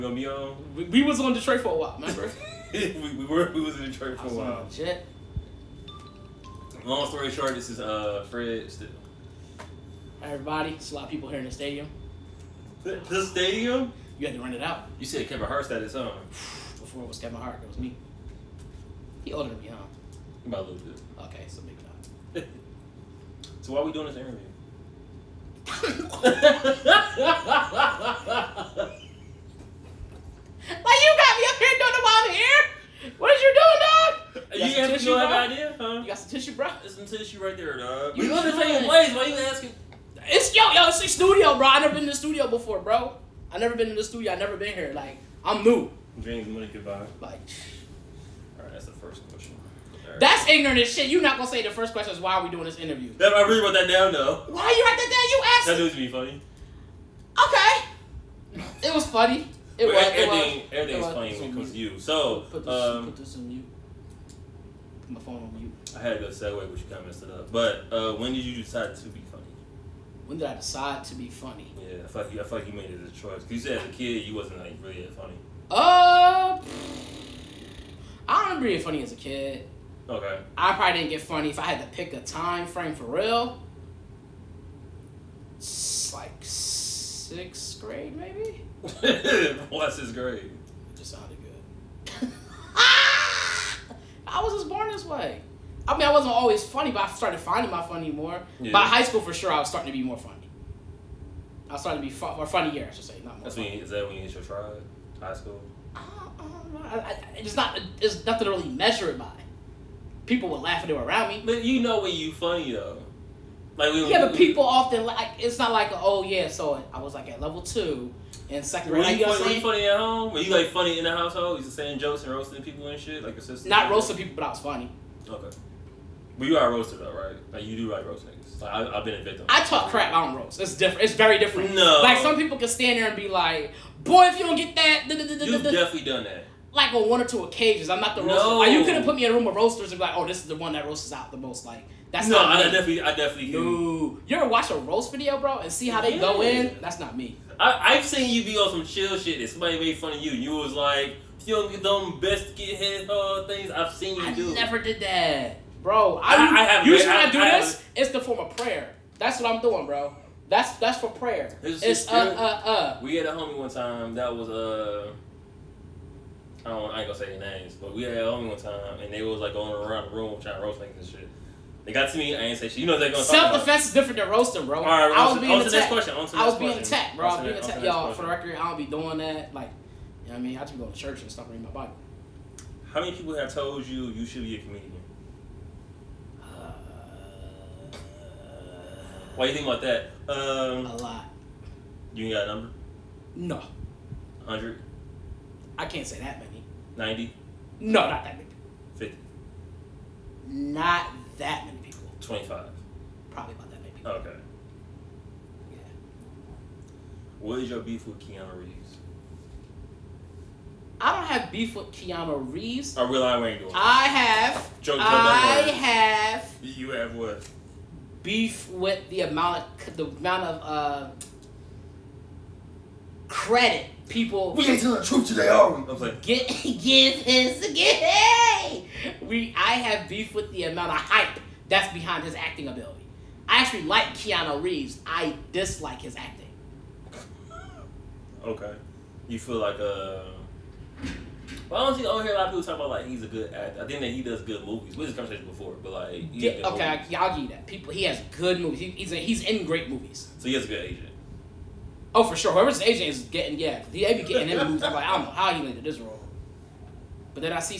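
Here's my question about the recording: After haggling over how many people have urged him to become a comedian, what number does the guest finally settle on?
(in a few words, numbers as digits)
25.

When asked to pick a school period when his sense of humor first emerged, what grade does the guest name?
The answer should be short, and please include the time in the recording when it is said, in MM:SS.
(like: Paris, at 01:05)
Sixth grade, at 01:26.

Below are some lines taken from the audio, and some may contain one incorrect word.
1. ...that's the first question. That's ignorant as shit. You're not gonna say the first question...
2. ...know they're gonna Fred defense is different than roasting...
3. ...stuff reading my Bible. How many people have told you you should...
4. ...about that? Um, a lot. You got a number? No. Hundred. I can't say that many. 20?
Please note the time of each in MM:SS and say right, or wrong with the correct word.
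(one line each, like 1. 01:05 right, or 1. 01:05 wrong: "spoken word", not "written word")
1. 00:48 right
2. 02:52 wrong: "Self", not "Fred"
3. 03:01 right
4. 03:09 wrong: "90", not "20".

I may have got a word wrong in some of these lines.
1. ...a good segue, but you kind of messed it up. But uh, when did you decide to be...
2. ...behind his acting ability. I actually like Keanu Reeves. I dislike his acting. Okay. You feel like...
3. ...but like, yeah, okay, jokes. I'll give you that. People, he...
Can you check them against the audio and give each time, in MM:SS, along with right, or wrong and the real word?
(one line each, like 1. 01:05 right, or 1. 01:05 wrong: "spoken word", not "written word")
1. 01:06 right
2. 03:51 right
3. 04:05 wrong: "movies", not "jokes".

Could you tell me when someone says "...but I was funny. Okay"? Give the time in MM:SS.
02:04.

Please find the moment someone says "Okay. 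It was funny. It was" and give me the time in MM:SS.
00:57.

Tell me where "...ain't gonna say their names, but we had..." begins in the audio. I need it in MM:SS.
02:46.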